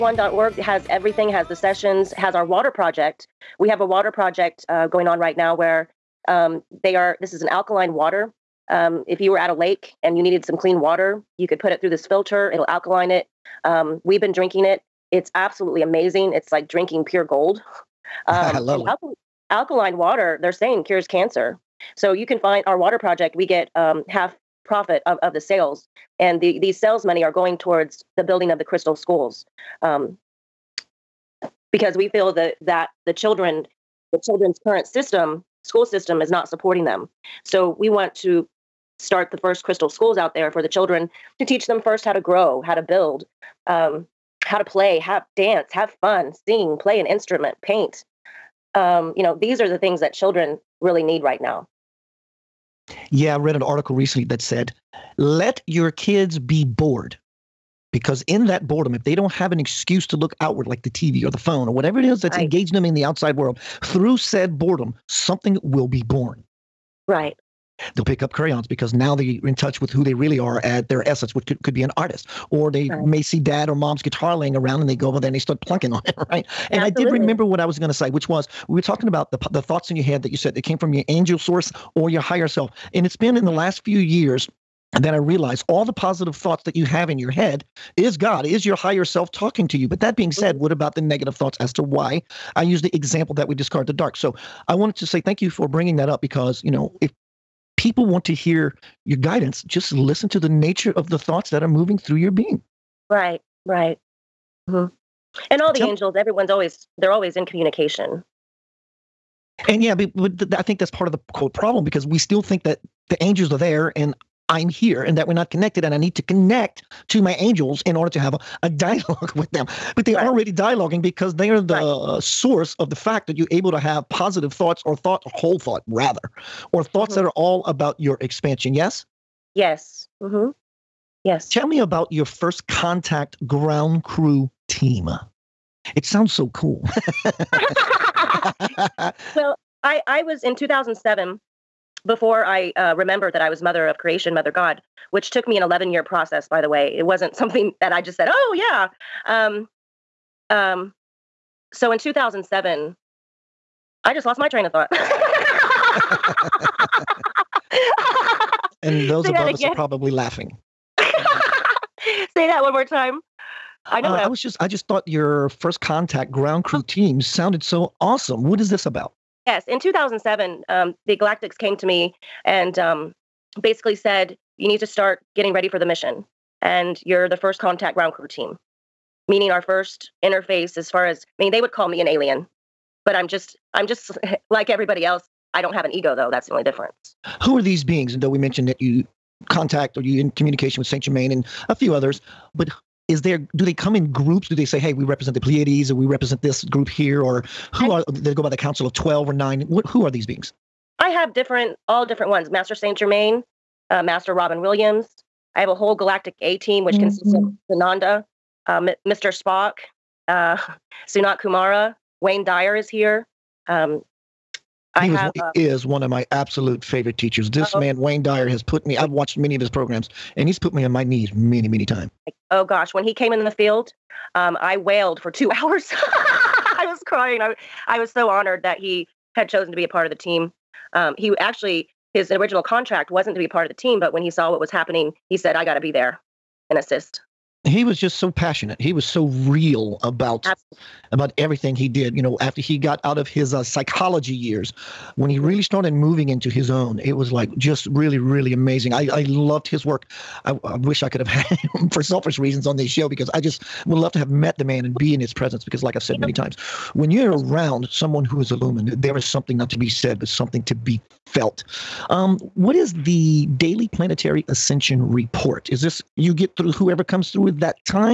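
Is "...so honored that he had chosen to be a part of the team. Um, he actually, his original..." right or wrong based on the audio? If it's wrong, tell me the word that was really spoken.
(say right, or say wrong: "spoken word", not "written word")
right.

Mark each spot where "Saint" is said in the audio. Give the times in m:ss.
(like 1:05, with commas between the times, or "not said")
3:10, 3:22.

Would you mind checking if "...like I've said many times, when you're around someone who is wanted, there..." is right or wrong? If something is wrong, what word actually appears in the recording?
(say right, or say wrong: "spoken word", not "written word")
wrong: "illumined", not "wanted".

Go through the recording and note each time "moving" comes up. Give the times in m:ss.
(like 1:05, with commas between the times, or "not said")
1:41, 4:05.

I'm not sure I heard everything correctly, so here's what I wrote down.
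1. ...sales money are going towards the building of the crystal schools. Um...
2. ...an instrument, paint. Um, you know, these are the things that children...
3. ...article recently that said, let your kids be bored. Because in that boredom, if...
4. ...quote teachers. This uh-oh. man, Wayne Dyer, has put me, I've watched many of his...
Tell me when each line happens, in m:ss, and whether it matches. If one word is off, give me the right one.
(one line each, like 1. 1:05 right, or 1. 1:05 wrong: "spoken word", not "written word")
1. 0:26 right
2. 0:46 right
3. 0:53 right
4. 3:36 wrong: "favorite", not "quote".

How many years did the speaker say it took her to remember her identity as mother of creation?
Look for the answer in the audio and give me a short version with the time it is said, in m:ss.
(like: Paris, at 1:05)
11, at 2:25.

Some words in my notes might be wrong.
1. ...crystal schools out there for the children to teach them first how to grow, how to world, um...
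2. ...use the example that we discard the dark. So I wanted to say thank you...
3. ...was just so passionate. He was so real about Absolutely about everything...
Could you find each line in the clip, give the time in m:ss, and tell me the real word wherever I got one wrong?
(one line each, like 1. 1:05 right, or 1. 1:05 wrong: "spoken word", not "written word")
1. 0:39 wrong: "build", not "world"
2. 1:32 right
3. 3:57 right.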